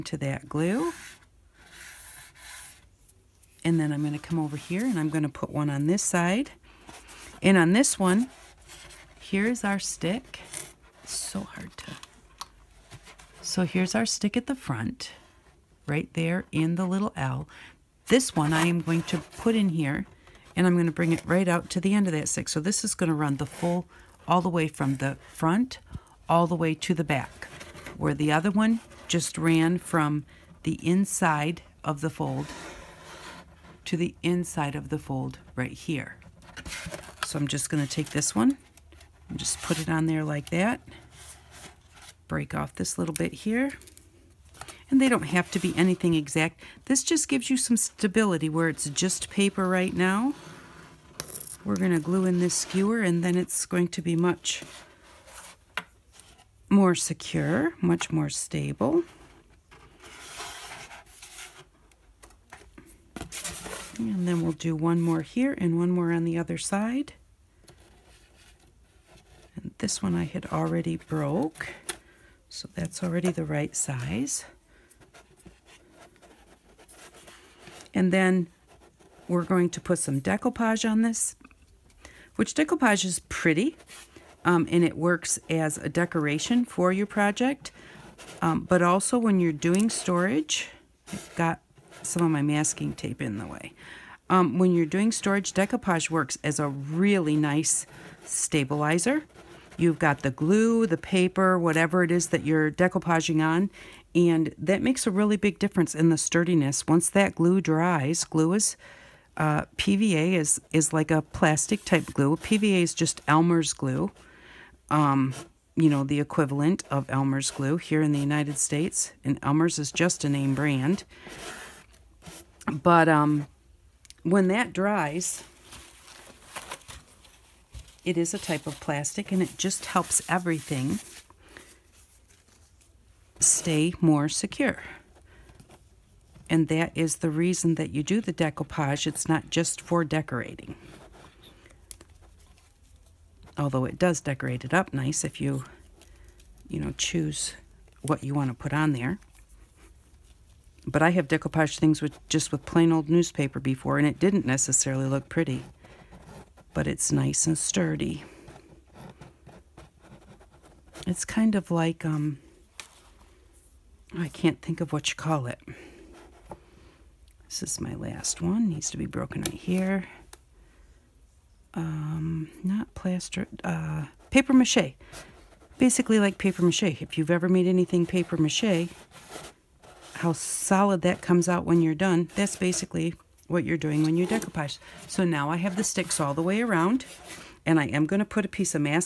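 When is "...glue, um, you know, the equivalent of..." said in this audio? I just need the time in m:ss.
1:53.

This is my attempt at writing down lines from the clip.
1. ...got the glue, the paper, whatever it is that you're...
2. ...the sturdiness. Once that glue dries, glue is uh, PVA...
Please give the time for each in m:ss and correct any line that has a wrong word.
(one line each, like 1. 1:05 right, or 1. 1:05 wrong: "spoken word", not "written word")
1. 1:39 right
2. 1:46 right.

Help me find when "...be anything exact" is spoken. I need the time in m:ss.
0:45.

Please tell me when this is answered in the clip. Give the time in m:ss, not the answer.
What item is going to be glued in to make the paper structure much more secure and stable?
0:52.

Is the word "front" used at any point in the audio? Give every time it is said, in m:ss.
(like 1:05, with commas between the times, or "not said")
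0:14, 0:25.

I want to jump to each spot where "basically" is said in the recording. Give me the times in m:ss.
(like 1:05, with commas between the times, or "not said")
2:55, 3:02.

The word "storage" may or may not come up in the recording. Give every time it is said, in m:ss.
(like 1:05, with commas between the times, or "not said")
1:29, 1:35.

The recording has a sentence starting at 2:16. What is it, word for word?
And that is the reason that you do the decoupage.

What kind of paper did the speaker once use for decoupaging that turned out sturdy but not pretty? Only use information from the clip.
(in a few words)
newspaper.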